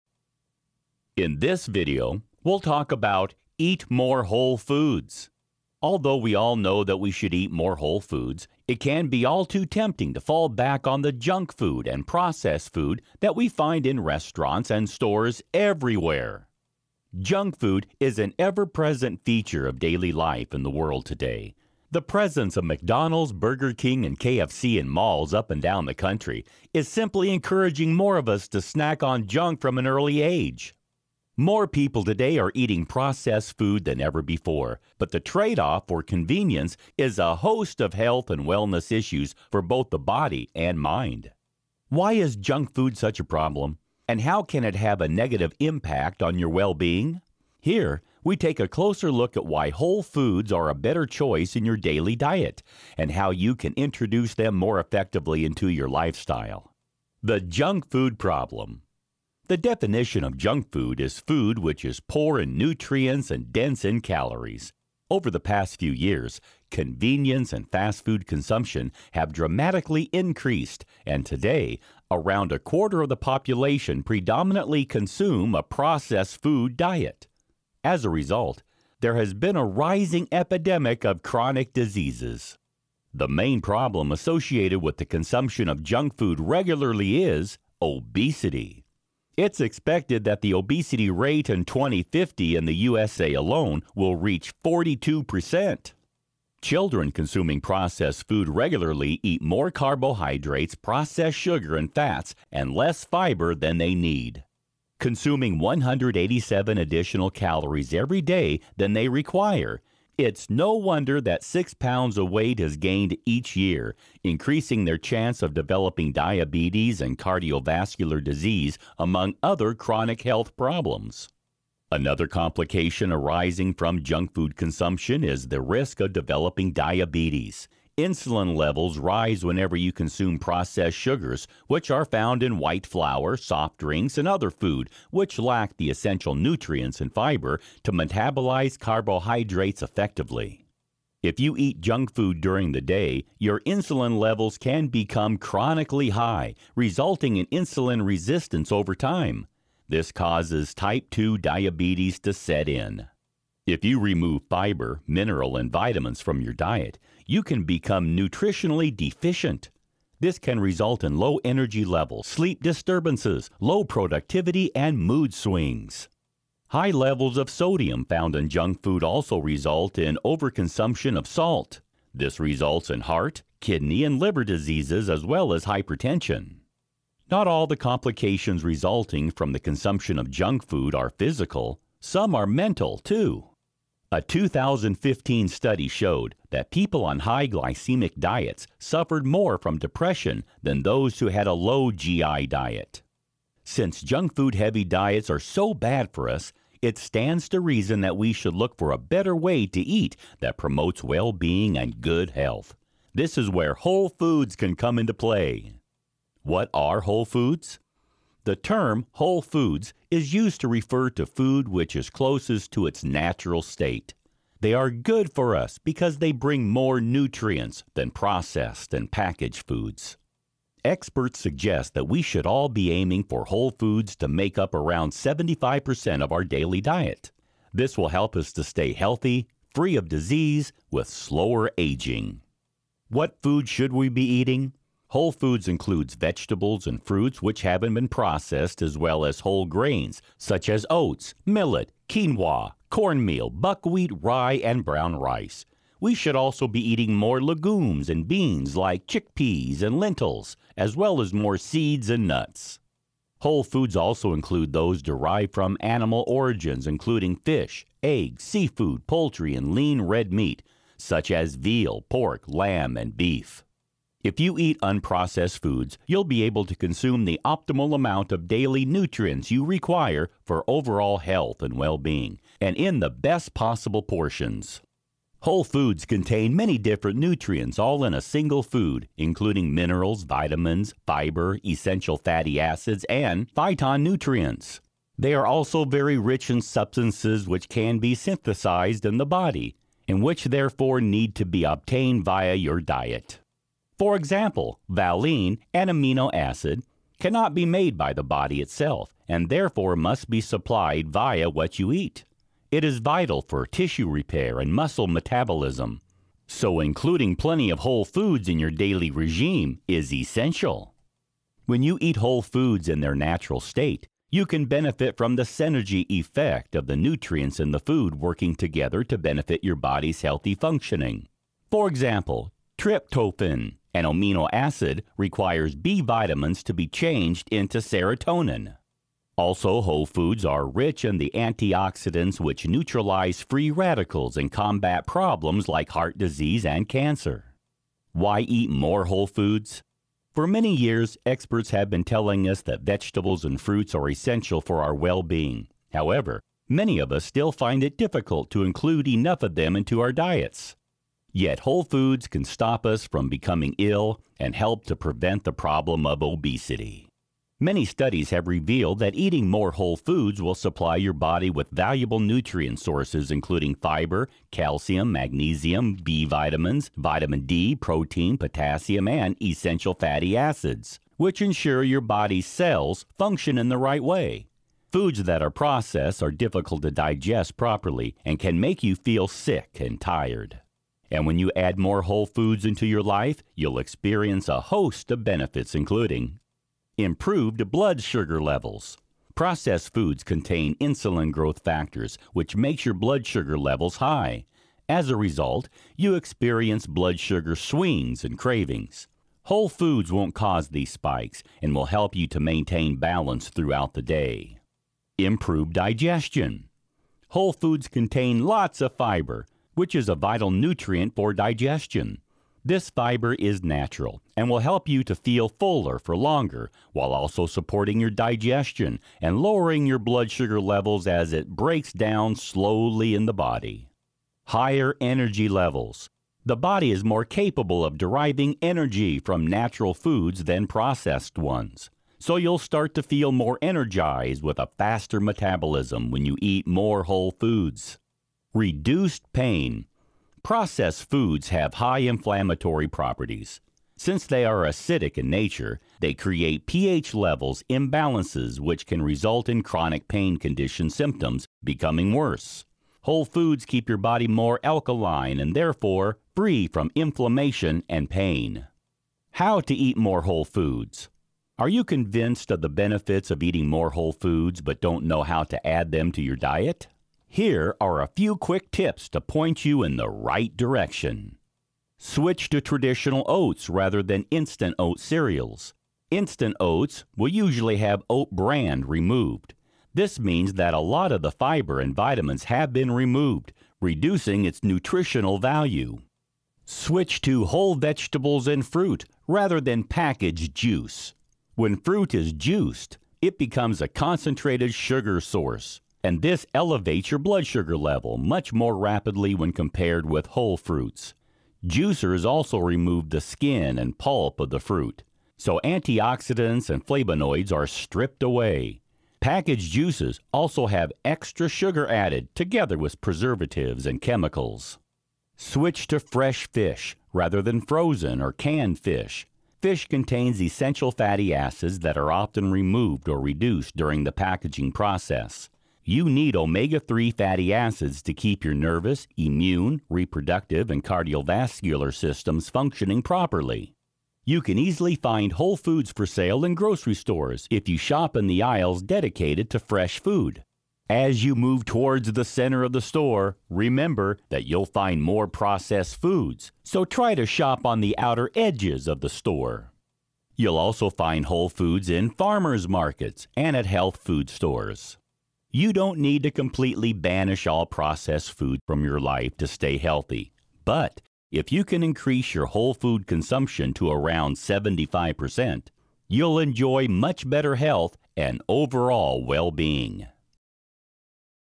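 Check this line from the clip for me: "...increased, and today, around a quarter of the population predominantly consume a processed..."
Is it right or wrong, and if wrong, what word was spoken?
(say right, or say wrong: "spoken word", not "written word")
right.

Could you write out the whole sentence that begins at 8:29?
Packaged juices also have extra sugar added together with preservatives and chemicals.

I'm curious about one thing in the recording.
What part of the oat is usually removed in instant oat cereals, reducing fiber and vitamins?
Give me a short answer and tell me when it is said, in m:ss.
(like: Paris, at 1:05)
Oat bran, at 7:58.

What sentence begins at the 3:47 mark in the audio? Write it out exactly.
This will help us to stay healthy, free of disease, with slower aging.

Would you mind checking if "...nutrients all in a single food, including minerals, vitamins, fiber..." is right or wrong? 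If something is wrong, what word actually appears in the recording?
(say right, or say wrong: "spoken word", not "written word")
right.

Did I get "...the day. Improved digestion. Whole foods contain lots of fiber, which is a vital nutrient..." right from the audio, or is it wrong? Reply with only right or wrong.
right.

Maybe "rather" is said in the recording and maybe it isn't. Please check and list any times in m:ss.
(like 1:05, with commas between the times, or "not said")
7:53, 8:09, 8:37.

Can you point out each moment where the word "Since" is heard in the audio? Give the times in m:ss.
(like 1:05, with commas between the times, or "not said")
3:13, 7:23.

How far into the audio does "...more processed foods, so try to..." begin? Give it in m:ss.
9:05.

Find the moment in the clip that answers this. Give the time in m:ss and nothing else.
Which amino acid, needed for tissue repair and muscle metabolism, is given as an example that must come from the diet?
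4:54.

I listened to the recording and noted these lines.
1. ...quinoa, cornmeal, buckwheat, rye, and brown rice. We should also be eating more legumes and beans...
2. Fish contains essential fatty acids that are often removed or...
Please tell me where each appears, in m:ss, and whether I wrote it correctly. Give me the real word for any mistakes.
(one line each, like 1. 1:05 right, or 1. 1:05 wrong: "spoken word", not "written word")
1. 4:02 right
2. 8:39 right.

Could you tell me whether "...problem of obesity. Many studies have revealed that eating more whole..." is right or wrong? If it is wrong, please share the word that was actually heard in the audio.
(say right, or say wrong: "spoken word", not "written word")
right.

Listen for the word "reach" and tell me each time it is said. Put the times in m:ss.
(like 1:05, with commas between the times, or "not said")
1:34.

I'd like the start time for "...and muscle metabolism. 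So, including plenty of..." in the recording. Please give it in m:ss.
5:04.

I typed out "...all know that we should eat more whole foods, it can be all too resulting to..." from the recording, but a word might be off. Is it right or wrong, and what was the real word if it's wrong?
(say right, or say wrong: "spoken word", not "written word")
wrong: "tempting", not "resulting".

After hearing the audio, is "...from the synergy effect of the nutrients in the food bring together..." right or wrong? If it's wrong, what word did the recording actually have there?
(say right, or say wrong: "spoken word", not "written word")
wrong: "working", not "bring".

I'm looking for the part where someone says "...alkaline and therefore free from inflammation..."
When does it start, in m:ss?
7:34.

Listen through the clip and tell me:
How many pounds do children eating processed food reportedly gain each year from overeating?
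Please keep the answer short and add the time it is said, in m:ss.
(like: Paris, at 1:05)
6, at 1:51.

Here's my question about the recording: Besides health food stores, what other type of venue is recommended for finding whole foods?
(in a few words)
Farmers markets.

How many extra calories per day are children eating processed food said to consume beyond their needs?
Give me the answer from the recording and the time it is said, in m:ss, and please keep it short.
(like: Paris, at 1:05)
187, at 1:45.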